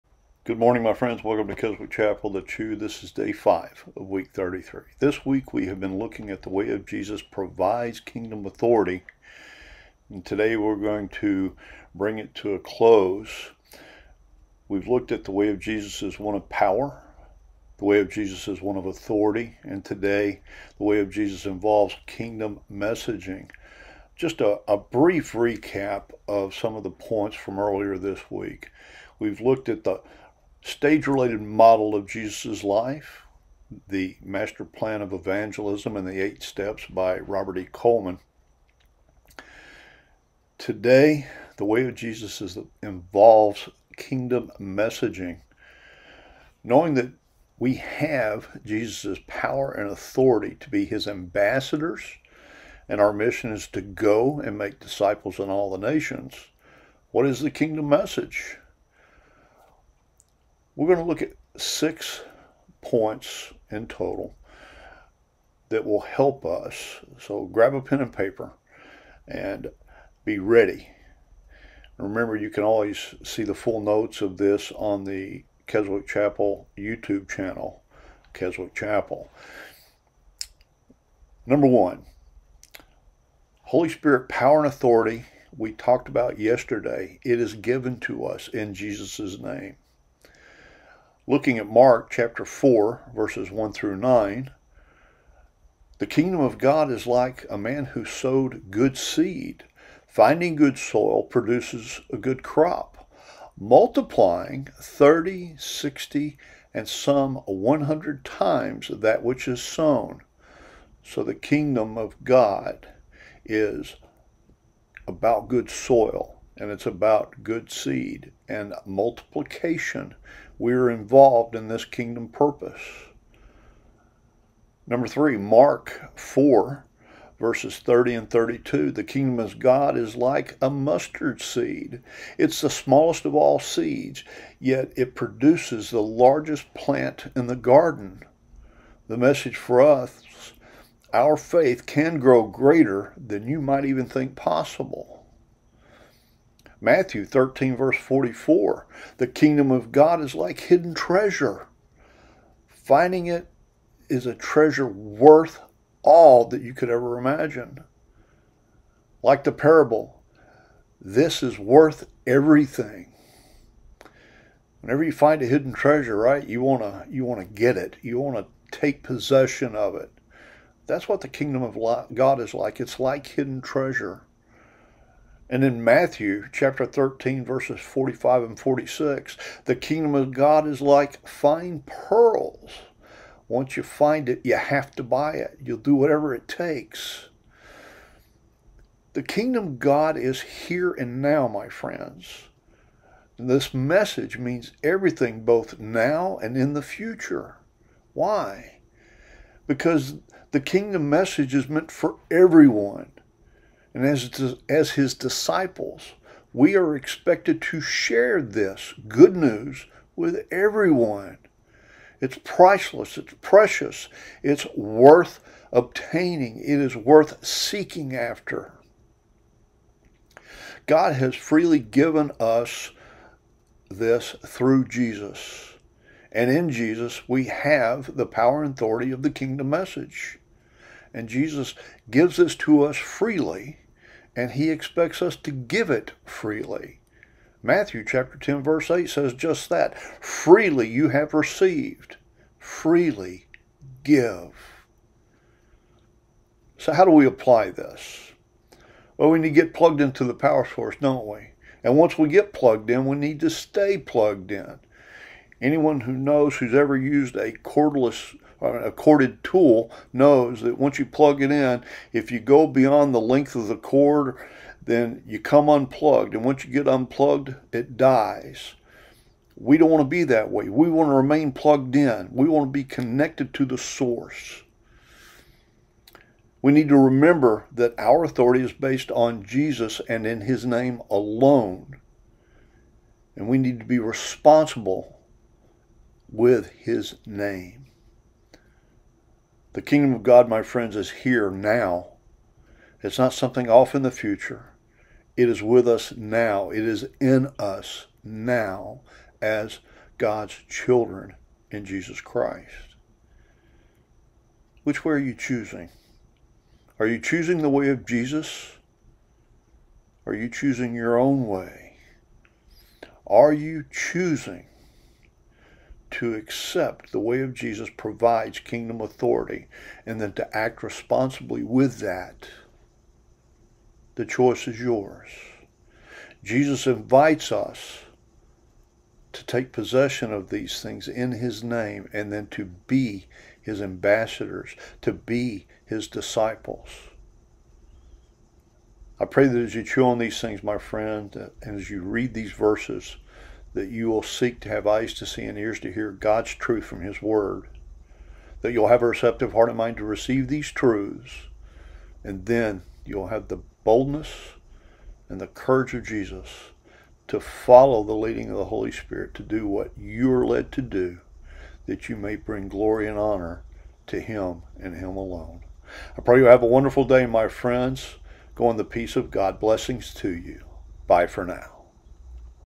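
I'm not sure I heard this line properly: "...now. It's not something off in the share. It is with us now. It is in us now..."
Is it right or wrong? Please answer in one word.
wrong.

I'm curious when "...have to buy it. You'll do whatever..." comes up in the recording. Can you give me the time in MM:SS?
03:04.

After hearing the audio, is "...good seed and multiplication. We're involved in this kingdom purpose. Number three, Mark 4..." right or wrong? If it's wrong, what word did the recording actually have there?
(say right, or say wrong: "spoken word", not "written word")
right.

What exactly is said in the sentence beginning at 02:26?
Matthew 13, verse 44 The kingdom of God is like hidden treasure.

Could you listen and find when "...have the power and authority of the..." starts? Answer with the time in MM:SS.
03:47.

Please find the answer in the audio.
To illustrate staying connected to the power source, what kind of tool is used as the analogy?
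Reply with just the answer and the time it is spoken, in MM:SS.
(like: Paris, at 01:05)
A corded tool, at 04:18.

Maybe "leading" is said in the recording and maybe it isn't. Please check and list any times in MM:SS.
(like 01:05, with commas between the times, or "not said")
05:58.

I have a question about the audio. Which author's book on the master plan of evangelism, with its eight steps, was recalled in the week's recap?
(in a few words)
Robert E. Coleman.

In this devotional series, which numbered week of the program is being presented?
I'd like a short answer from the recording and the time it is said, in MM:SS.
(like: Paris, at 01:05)
33, at 00:04.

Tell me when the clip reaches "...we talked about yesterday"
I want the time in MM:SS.
01:25.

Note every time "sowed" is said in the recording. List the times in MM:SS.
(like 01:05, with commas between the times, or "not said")
01:38.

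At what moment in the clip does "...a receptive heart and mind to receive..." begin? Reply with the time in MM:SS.
05:49.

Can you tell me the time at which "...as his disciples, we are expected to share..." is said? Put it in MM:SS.
03:24.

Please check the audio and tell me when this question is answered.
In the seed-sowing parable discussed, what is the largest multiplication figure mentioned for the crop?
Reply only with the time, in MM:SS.
01:47.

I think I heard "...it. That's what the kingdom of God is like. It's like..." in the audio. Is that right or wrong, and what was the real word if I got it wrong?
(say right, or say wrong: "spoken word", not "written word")
right.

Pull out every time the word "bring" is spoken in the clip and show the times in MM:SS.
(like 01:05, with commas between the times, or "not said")
00:11, 06:02.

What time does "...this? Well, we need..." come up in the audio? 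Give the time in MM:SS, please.
04:07.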